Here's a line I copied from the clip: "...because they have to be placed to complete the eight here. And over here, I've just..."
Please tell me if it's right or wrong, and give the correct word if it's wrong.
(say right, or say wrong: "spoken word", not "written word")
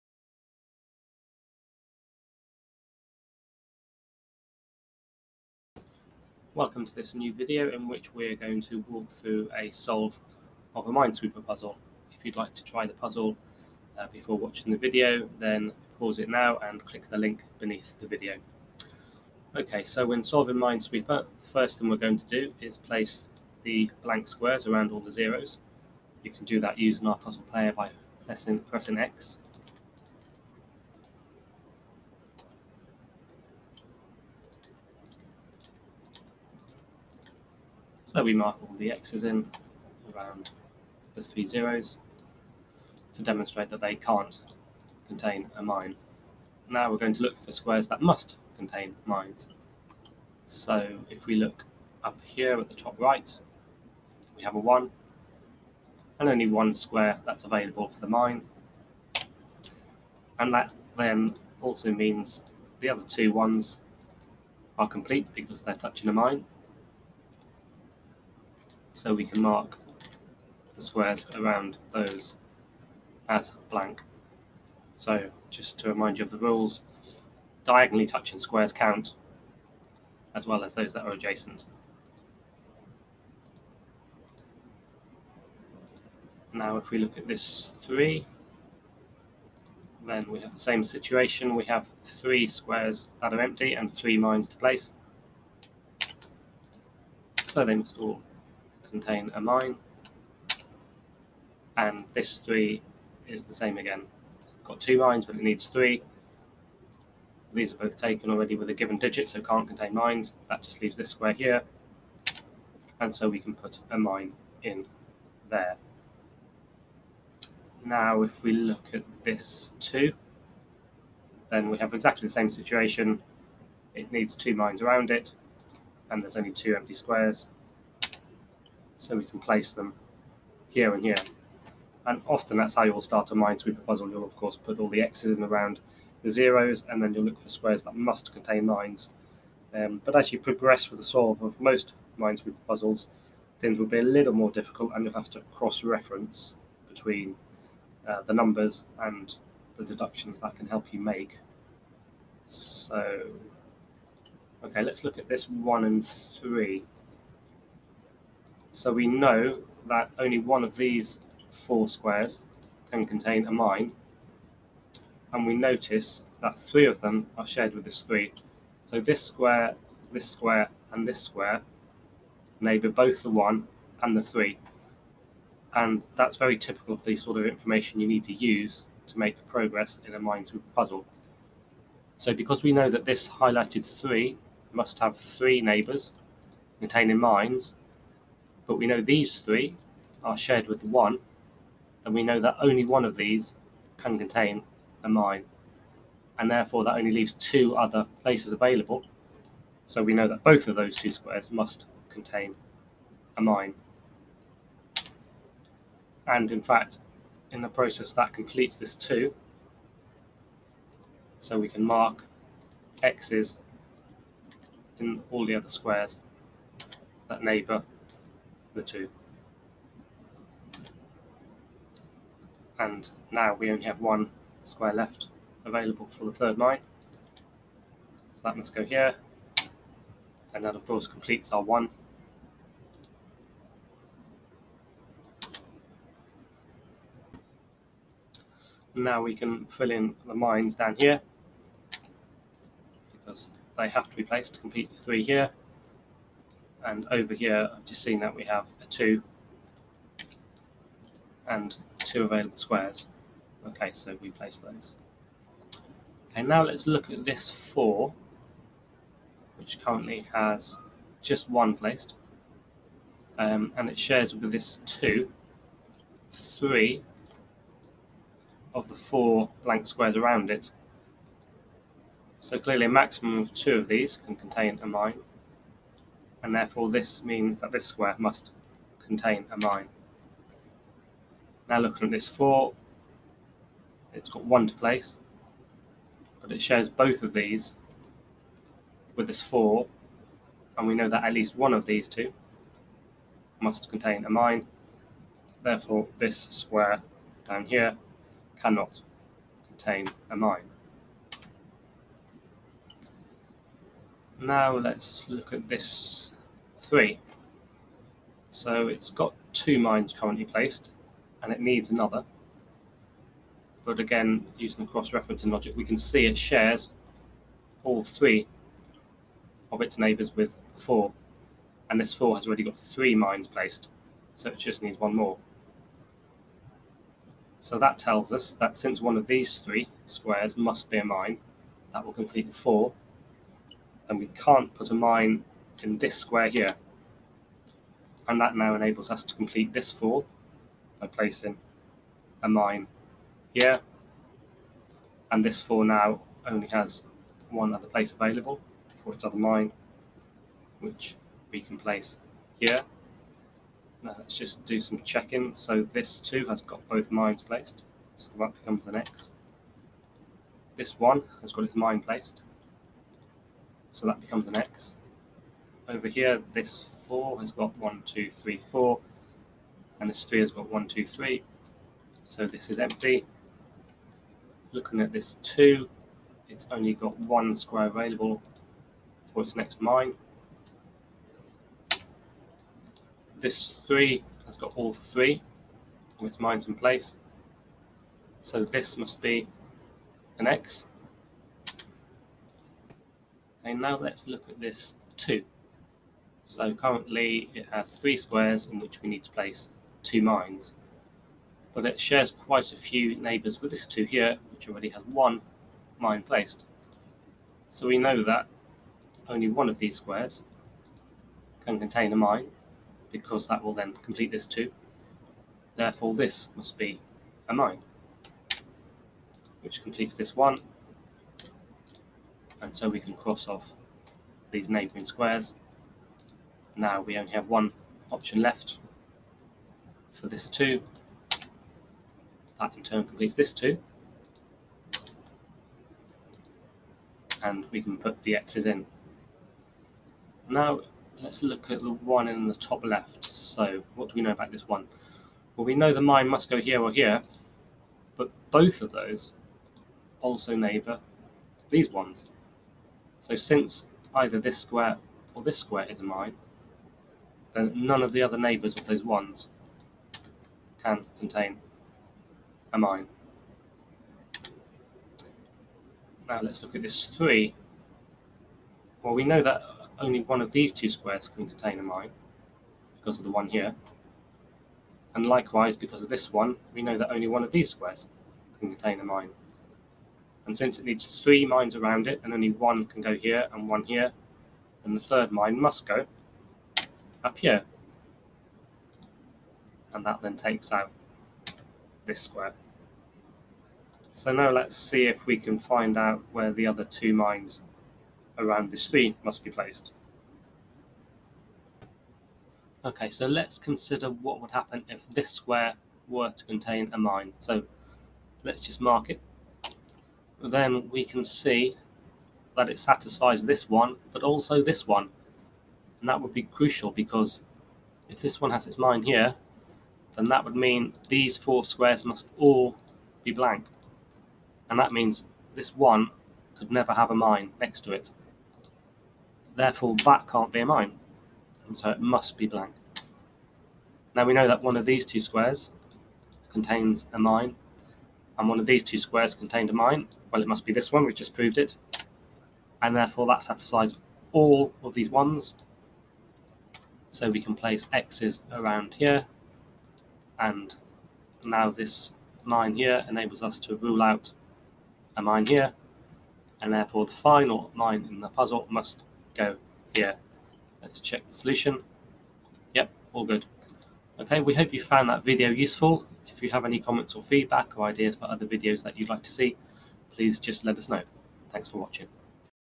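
wrong: "three", not "eight".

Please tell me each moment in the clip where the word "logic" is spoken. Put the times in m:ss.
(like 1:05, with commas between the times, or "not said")
5:15.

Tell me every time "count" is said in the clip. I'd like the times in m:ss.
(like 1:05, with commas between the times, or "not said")
1:18.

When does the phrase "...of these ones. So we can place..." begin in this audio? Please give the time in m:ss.
9:04.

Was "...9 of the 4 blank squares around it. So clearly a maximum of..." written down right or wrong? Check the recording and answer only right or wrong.
wrong.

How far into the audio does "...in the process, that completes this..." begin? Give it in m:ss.
3:27.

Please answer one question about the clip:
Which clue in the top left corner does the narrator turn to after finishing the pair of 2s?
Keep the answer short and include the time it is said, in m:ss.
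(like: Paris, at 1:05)
1, at 7:21.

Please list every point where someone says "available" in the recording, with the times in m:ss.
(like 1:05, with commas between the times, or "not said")
0:57, 3:18, 3:45, 4:12, 5:48, 6:17.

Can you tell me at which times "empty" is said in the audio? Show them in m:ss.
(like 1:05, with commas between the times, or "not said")
1:33, 2:06, 6:12.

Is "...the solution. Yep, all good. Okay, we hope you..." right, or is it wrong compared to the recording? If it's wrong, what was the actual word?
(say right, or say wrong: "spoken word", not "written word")
right.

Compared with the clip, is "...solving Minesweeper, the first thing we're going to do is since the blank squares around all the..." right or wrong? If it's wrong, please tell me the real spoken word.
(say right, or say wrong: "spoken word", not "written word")
wrong: "place", not "since".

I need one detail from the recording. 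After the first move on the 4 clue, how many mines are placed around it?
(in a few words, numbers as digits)
1.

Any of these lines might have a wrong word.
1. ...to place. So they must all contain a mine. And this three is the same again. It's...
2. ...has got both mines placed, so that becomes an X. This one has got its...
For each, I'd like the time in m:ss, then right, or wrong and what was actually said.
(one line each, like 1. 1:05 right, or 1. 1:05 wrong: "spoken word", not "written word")
1. 1:34 right
2. 5:56 right.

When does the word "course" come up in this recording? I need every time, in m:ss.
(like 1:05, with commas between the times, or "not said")
2:14, 3:50.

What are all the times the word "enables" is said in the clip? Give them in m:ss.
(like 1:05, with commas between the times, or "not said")
5:38, 9:13.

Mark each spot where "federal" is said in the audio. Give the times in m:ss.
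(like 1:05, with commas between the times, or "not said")
not said.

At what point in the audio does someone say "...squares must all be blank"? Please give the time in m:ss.
8:41.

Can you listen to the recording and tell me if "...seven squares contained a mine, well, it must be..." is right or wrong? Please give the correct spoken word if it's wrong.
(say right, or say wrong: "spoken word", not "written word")
wrong: "two", not "seven".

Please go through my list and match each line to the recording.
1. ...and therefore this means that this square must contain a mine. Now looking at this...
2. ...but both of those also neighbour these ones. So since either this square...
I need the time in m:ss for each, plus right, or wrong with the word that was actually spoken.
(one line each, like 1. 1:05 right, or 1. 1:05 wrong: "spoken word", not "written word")
1. 4:36 right
2. 7:28 right.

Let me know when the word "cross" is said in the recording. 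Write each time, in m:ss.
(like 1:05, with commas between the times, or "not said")
2:25, 5:14, 7:03.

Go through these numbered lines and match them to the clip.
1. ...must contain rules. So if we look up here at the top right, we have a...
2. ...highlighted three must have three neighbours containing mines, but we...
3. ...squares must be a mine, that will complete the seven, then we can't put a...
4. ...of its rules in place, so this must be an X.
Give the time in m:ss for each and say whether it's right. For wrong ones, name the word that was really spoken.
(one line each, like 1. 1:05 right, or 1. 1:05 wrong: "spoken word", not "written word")
1. 0:48 wrong: "mines", not "rules"
2. 3:03 right
3. 5:30 wrong: "four", not "seven"
4. 6:26 wrong: "mines", not "rules".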